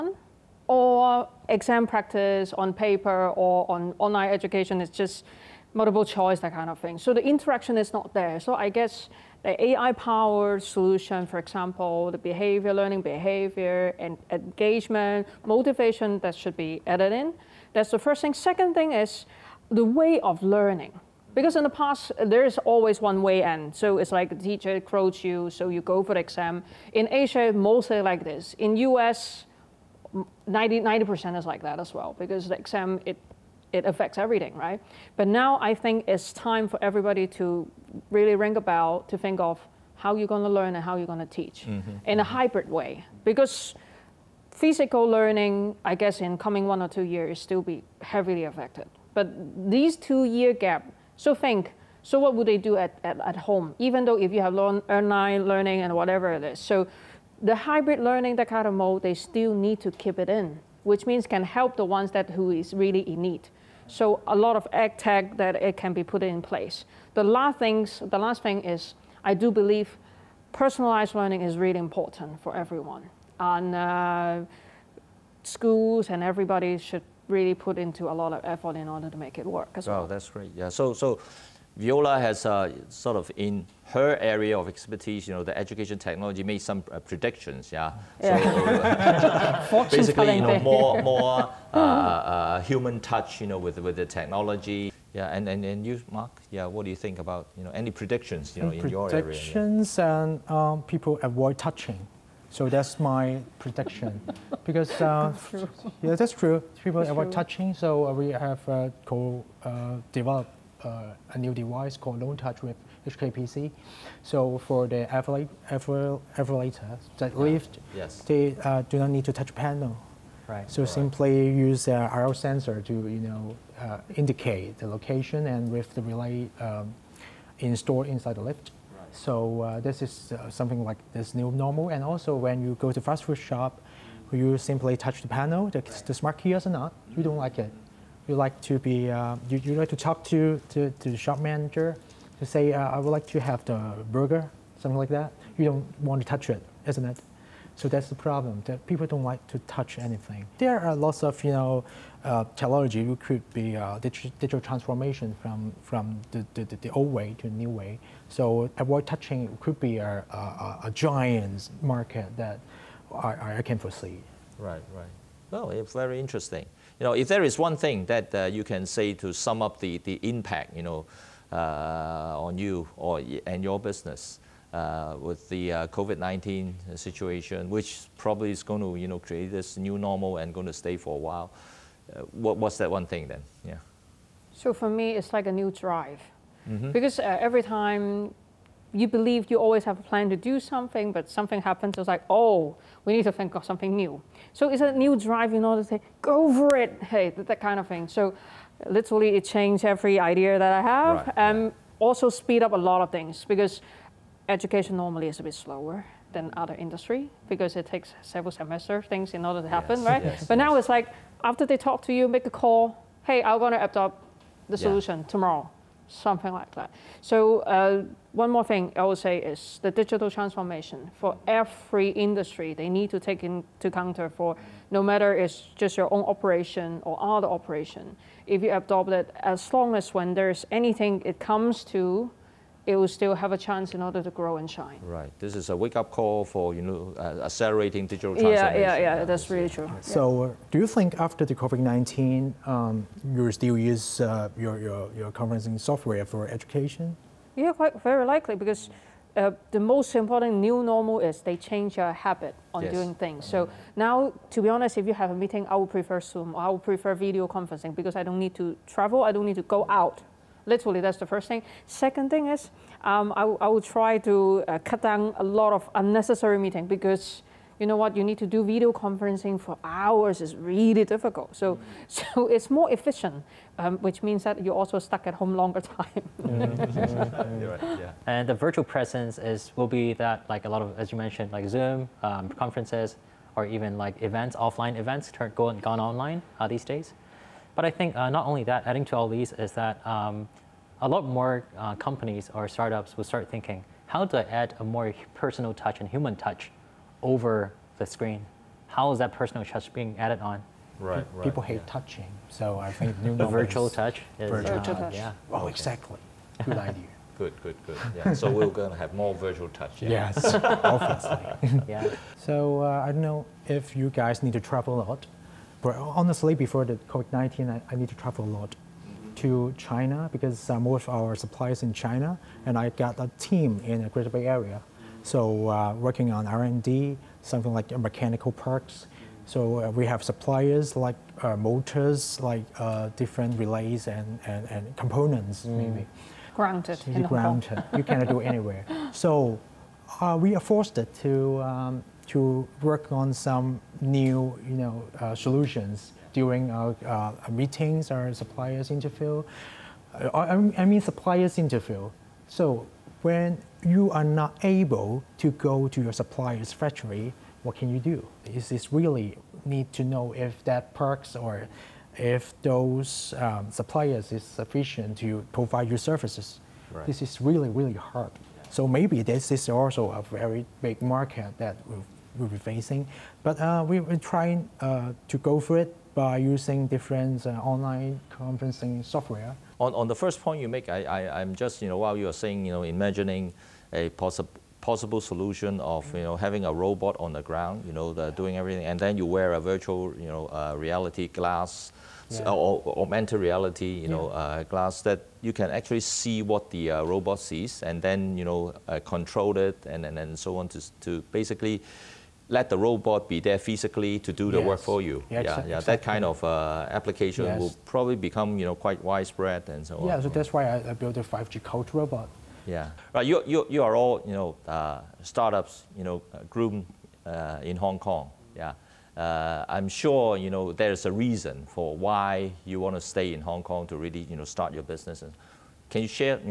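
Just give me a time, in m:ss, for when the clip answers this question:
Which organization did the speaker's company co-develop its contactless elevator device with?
1:53.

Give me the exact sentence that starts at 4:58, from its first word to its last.
How is that personal touch being added on?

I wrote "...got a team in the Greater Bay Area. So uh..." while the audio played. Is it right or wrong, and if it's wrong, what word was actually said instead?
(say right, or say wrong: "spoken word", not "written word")
right.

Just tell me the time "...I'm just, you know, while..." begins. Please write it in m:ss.
6:21.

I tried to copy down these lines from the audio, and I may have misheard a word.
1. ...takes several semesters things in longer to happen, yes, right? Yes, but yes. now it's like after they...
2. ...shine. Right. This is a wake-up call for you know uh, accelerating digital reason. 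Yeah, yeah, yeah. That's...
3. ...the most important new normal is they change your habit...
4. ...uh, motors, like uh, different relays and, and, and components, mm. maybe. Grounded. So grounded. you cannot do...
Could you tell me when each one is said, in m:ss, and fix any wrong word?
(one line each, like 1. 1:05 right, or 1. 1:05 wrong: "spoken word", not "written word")
1. 3:27 wrong: "order", not "longer"
2. 3:54 wrong: "transformation", not "reason"
3. 4:09 right
4. 5:31 right.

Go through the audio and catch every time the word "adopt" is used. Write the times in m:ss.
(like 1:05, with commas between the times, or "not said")
3:33, 3:48.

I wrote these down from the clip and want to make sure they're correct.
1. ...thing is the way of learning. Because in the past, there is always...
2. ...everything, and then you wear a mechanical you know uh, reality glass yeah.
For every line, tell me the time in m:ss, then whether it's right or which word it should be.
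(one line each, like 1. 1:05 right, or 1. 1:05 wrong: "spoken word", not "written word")
1. 0:18 right
2. 6:28 wrong: "virtual", not "mechanical".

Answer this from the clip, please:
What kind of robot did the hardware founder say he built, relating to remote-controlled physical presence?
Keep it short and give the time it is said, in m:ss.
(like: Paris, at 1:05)
5G coach robot, at 6:51.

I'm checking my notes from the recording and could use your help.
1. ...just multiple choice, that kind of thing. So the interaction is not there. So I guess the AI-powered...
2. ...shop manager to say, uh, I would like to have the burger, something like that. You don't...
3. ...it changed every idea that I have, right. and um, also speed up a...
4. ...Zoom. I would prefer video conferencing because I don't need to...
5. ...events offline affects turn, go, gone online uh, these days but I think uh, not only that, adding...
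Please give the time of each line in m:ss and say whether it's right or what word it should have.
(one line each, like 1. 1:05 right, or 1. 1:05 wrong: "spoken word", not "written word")
1. 0:04 right
2. 2:21 right
3. 3:19 right
4. 4:16 right
5. 4:44 wrong: "events", not "affects".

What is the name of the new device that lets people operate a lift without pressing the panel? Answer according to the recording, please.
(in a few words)
Lone Touch.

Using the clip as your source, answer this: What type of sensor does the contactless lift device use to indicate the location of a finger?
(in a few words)
RL sensor.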